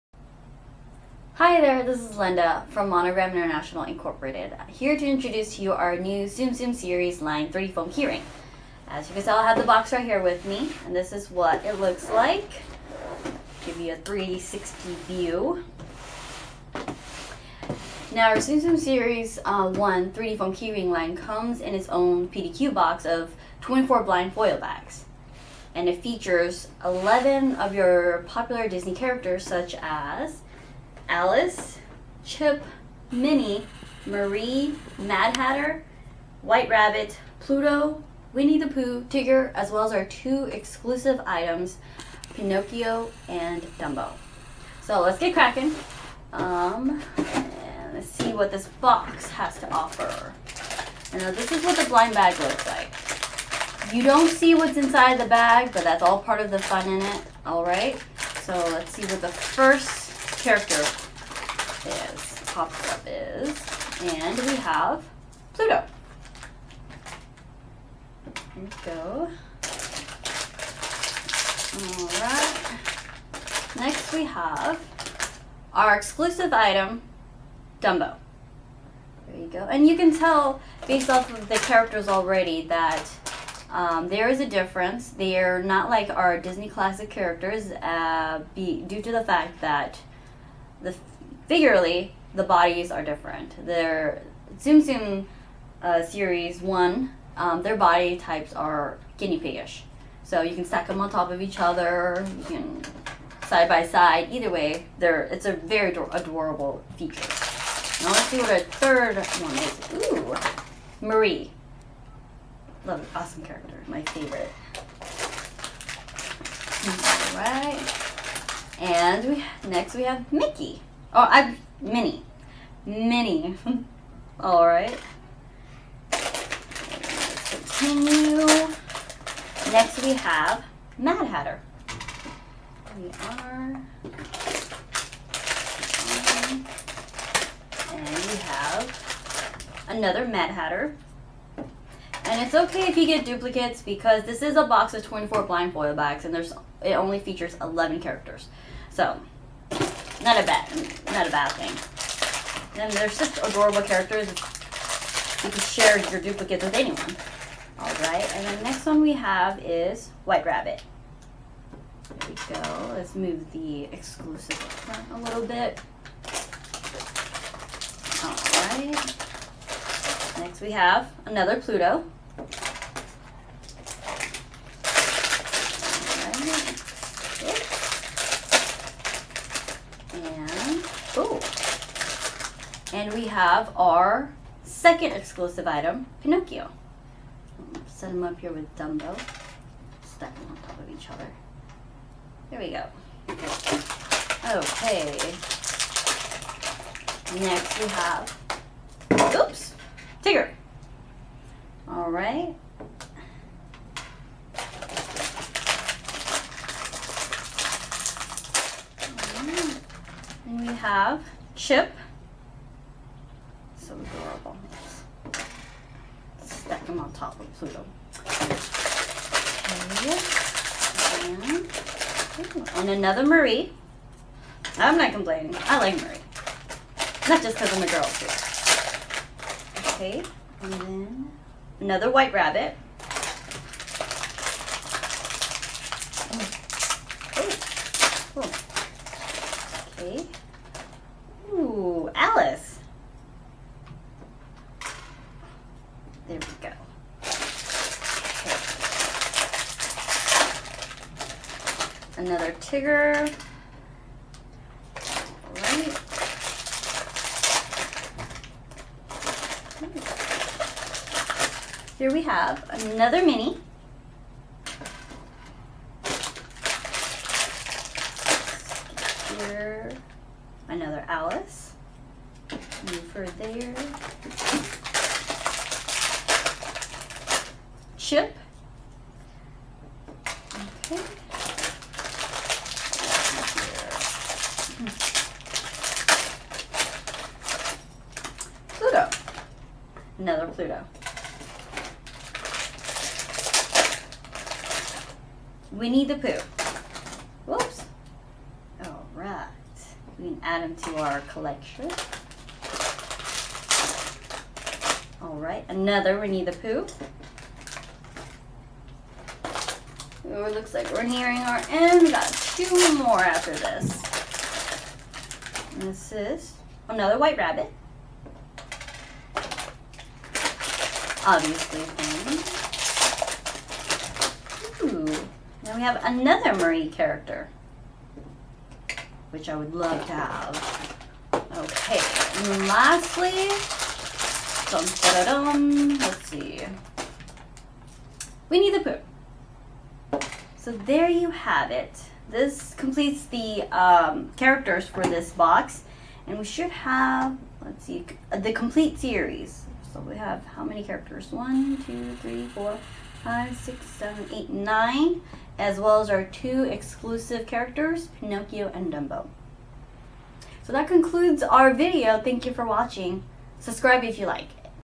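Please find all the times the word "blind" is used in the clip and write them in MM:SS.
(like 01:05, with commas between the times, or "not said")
00:24, 00:51, 02:25.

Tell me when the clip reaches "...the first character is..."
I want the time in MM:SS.
00:59.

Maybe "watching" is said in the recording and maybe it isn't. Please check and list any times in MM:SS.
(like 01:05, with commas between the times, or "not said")
06:02.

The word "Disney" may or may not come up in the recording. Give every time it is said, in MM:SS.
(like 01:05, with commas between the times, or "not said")
00:28, 01:26.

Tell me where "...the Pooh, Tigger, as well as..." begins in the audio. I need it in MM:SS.
00:38.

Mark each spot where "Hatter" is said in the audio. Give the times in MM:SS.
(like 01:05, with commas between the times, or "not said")
00:35, 02:11, 02:20.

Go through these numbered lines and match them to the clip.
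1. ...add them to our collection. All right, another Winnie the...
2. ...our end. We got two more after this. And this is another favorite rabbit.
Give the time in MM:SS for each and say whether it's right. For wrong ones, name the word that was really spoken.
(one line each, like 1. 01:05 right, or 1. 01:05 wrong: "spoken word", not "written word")
1. 05:00 right
2. 05:11 wrong: "white", not "favorite".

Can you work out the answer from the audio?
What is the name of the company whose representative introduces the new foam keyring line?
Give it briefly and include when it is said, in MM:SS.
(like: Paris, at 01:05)
Monogram International Incorporated, at 00:02.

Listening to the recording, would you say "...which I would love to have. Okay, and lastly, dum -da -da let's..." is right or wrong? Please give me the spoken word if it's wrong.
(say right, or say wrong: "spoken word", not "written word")
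right.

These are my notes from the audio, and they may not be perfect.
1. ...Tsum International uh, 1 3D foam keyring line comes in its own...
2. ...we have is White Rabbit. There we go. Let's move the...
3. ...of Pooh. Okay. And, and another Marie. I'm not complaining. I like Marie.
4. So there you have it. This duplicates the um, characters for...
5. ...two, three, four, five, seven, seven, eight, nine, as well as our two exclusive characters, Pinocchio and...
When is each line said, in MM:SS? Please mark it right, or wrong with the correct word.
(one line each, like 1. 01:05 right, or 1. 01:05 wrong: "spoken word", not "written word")
1. 00:18 wrong: "Series", not "International"
2. 02:39 right
3. 03:37 wrong: "Pluto", not "Pooh"
4. 05:40 wrong: "completes", not "duplicates"
5. 05:51 wrong: "six", not "seven".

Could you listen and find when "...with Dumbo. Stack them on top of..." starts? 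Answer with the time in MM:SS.
03:08.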